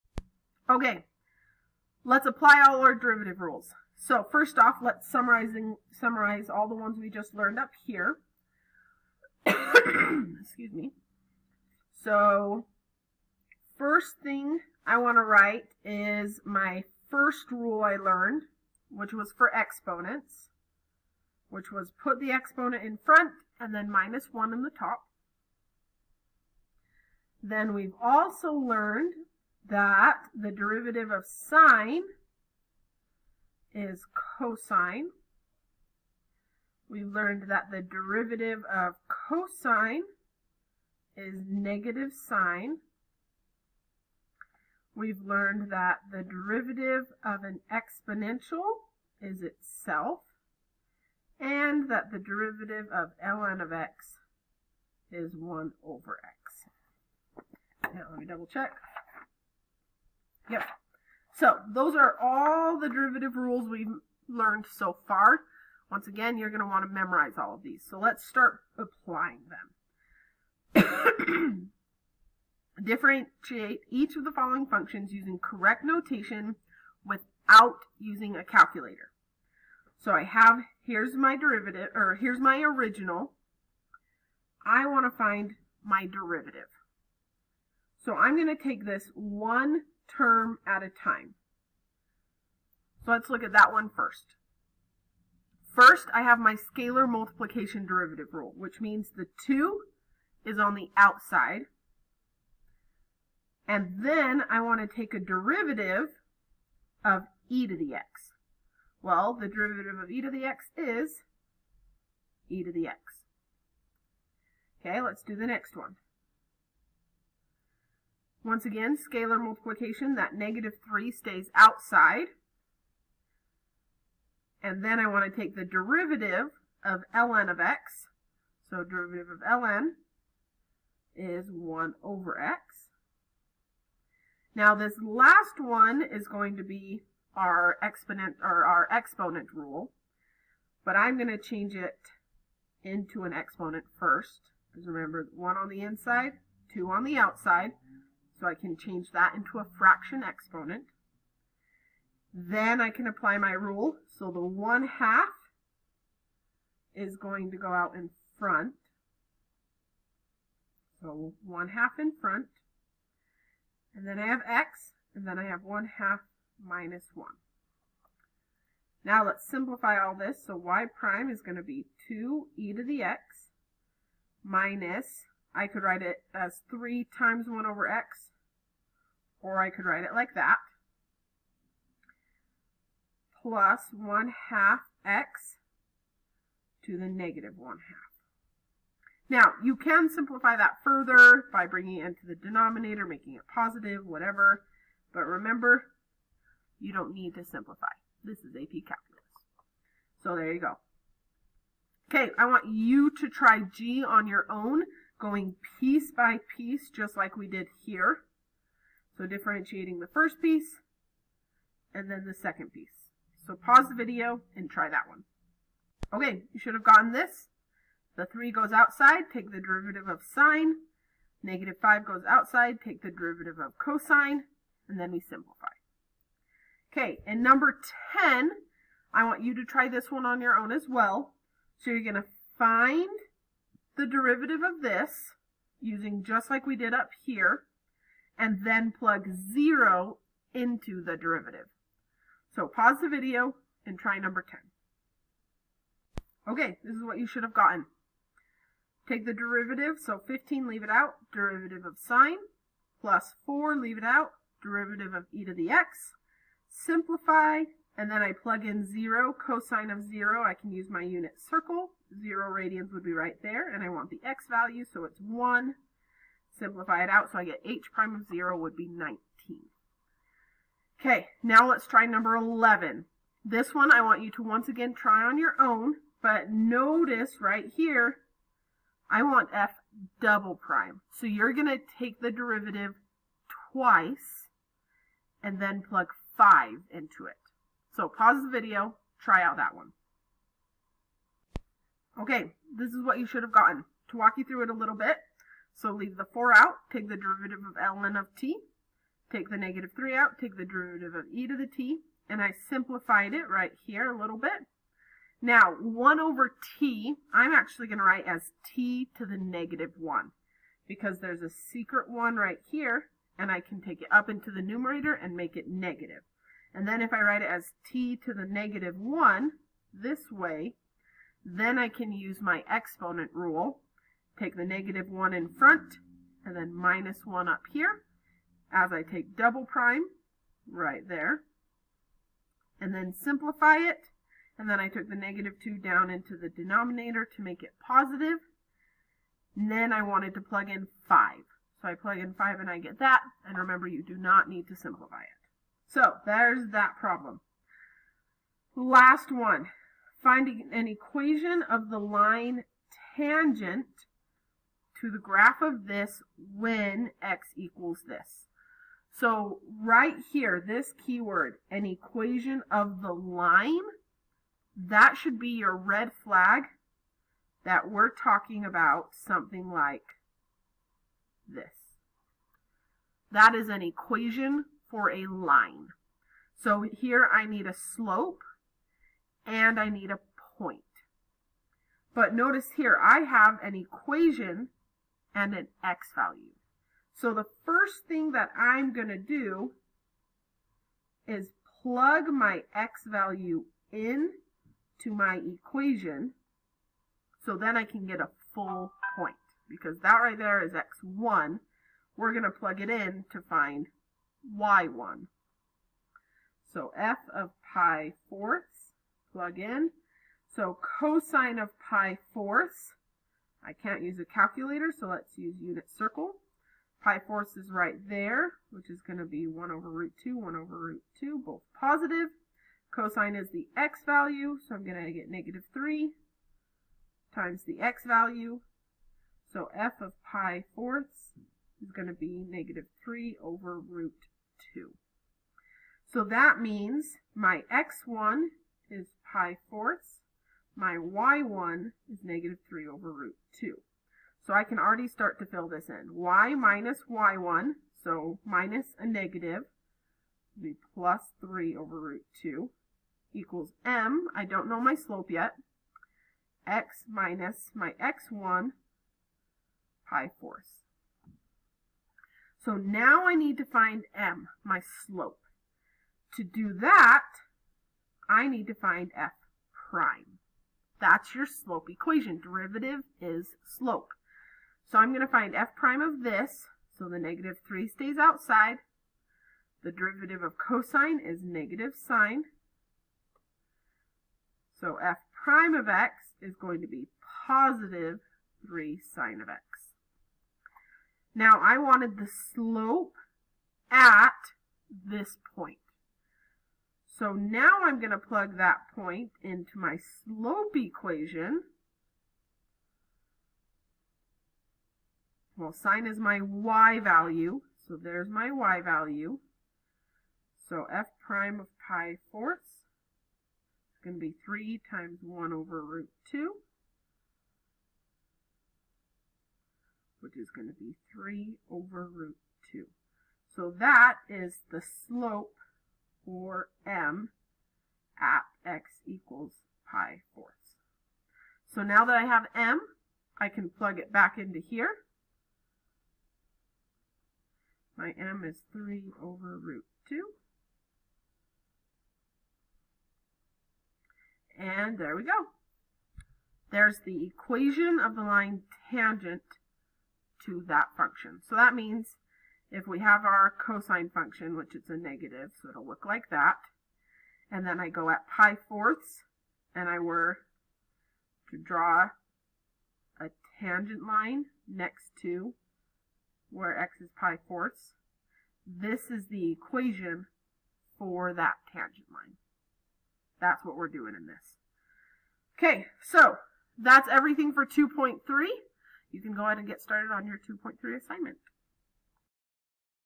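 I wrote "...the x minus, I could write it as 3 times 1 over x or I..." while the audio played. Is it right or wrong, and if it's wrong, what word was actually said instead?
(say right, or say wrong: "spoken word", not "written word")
right.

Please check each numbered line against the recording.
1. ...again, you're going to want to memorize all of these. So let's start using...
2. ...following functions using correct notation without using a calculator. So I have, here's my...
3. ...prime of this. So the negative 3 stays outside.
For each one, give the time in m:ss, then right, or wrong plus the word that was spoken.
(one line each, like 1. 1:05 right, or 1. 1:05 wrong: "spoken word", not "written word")
1. 1:06 wrong: "applying", not "using"
2. 1:14 right
3. 7:55 right.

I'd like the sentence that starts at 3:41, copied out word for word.
Negative 5 goes outside, take the derivative of cosine, and then we simplify.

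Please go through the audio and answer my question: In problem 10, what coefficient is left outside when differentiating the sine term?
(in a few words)
15.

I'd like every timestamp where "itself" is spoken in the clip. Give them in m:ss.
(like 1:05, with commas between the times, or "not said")
0:49.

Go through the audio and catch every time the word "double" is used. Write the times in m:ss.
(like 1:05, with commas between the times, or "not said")
0:58, 4:40, 5:29.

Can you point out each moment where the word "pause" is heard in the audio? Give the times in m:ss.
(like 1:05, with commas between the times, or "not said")
3:33, 4:02, 4:48.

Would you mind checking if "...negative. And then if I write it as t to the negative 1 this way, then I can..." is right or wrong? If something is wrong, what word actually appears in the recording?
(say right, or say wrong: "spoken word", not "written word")
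right.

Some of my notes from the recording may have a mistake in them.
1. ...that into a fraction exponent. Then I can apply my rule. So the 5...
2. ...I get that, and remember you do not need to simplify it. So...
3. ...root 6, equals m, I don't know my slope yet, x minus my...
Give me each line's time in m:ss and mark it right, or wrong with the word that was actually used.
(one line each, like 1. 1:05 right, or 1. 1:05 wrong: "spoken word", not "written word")
1. 2:29 wrong: "1", not "5"
2. 5:42 right
3. 7:31 wrong: "2", not "6".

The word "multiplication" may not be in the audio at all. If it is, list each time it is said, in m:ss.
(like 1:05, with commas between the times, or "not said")
1:37, 1:59.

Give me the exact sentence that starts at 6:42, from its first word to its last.
We're going to plug it in to find y1.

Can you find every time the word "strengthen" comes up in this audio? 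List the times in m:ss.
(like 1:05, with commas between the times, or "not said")
not said.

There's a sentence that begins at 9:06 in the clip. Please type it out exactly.
There's the equation of the line tangent to that function.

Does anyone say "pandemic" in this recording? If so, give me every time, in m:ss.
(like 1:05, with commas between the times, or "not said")
not said.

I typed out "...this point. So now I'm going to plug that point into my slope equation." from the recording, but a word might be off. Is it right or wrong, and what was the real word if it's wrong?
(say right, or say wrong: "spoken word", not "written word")
right.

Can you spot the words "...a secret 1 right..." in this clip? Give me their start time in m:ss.
5:11.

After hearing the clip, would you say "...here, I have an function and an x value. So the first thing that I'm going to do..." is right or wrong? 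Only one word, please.
wrong.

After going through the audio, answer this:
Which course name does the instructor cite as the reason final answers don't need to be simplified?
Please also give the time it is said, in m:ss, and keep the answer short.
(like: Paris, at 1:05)
AP Calculus, at 3:18.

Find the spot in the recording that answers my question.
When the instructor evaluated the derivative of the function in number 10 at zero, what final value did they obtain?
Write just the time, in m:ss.
4:28.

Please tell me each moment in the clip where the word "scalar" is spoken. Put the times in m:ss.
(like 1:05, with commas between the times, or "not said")
1:36, 1:58.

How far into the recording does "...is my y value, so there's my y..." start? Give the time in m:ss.
8:26.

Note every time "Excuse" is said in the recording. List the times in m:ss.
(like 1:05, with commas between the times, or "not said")
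0:09.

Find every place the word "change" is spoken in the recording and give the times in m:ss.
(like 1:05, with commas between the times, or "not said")
2:21, 2:28.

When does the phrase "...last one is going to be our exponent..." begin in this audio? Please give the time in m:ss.
2:15.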